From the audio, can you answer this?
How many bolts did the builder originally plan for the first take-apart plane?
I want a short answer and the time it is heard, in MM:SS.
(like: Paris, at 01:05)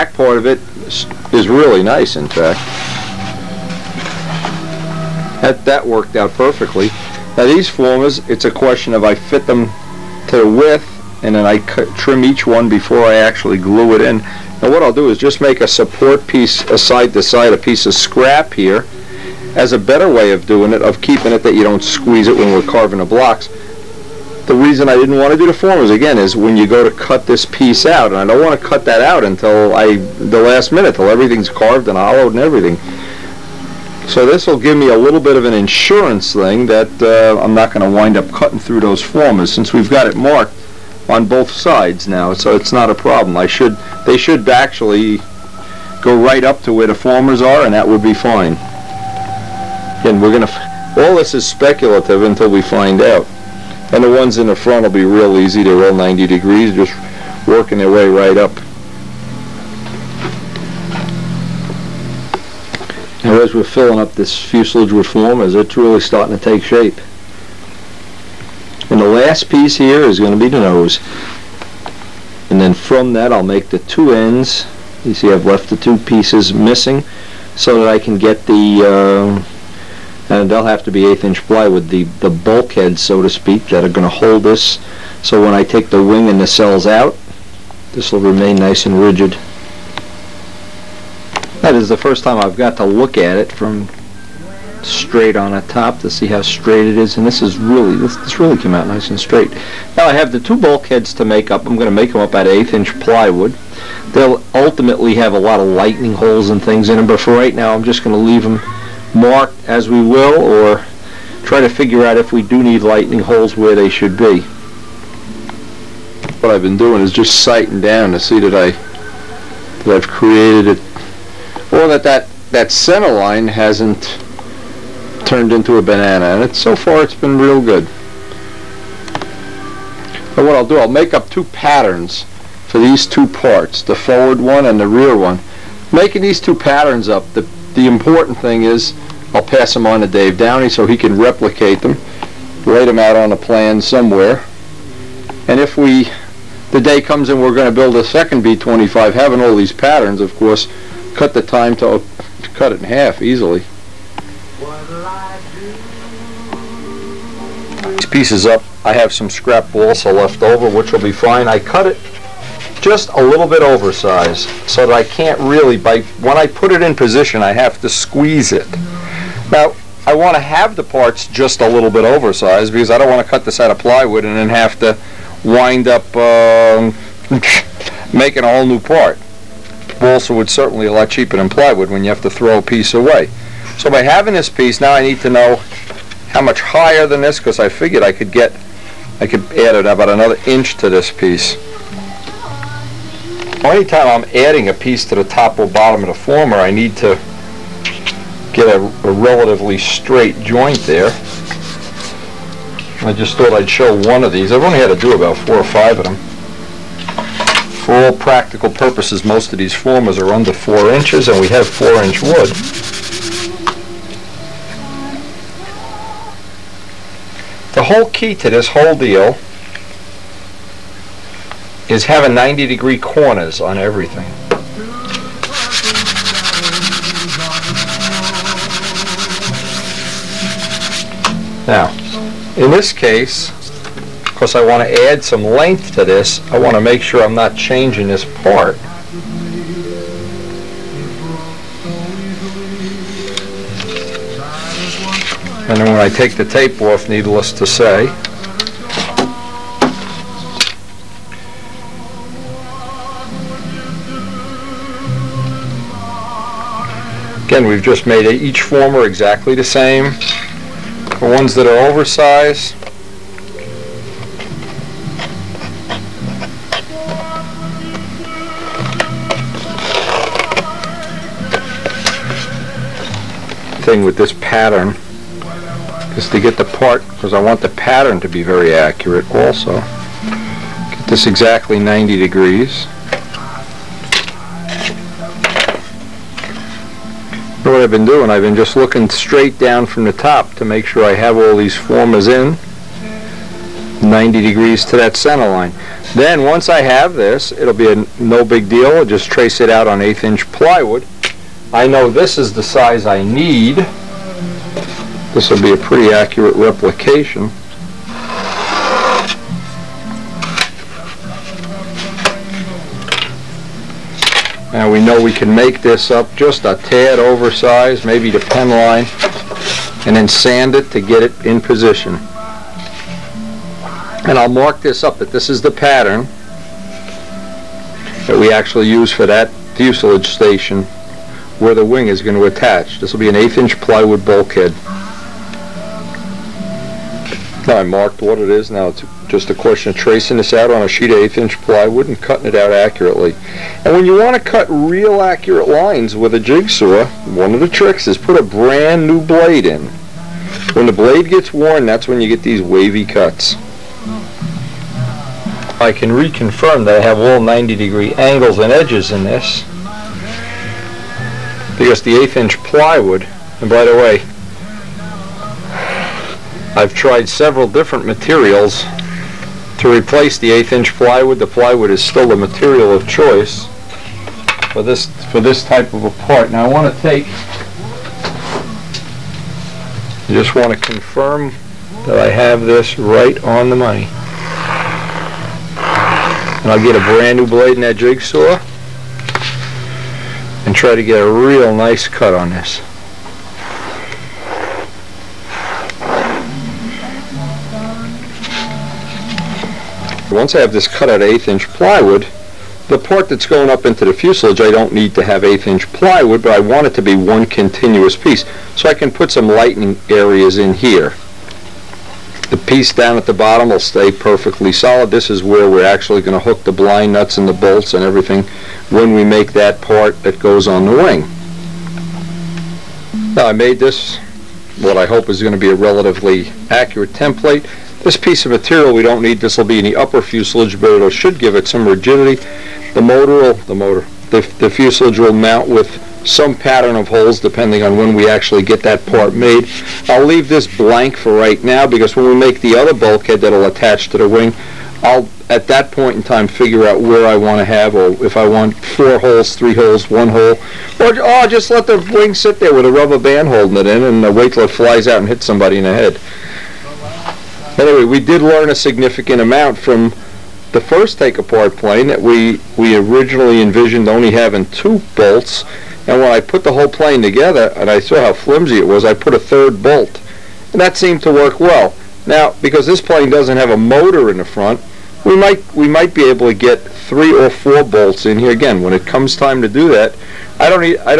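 2, at 07:44.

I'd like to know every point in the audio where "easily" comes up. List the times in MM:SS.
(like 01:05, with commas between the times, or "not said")
02:33.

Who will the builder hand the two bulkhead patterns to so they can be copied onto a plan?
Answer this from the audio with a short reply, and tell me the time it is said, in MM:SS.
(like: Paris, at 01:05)
Dave Downey, at 02:20.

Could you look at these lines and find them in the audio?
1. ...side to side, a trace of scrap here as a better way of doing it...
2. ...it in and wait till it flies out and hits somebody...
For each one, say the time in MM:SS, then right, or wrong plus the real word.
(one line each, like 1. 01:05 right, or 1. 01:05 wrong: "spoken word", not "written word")
1. 00:16 wrong: "piece", not "trace"
2. 07:33 right.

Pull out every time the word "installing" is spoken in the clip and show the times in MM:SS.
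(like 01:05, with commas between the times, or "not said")
not said.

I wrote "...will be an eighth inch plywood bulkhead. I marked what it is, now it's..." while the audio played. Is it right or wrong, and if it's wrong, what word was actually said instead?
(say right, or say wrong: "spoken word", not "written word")
right.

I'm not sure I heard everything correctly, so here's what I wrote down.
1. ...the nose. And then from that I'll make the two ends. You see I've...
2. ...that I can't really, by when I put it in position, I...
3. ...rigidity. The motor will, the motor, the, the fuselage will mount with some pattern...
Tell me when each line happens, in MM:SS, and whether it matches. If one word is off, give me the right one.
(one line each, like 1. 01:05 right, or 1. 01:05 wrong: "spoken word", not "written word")
1. 01:10 right
2. 02:44 right
3. 07:11 right.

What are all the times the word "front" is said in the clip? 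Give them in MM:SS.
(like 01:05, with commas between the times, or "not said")
00:54, 07:54.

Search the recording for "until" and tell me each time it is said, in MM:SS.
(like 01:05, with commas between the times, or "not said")
00:29, 00:52.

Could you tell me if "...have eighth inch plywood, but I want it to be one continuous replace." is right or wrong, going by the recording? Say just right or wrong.
wrong.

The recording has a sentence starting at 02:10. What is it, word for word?
But what I'll do, I'll make up two patterns for these two parts, the forward one and the rear one.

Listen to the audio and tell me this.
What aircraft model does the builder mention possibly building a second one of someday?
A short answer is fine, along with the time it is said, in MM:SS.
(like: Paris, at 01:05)
B-25, at 02:28.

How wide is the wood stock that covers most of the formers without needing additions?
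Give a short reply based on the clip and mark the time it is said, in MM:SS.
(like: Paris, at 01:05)
4 inches, at 03:31.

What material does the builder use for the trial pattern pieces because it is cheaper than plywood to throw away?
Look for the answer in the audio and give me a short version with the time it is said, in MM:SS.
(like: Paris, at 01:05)
Balsa, at 02:39.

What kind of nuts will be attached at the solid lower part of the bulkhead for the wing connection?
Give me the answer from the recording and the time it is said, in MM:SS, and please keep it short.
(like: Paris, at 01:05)
Blind nuts, at 06:56.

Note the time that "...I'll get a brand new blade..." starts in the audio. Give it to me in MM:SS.
06:26.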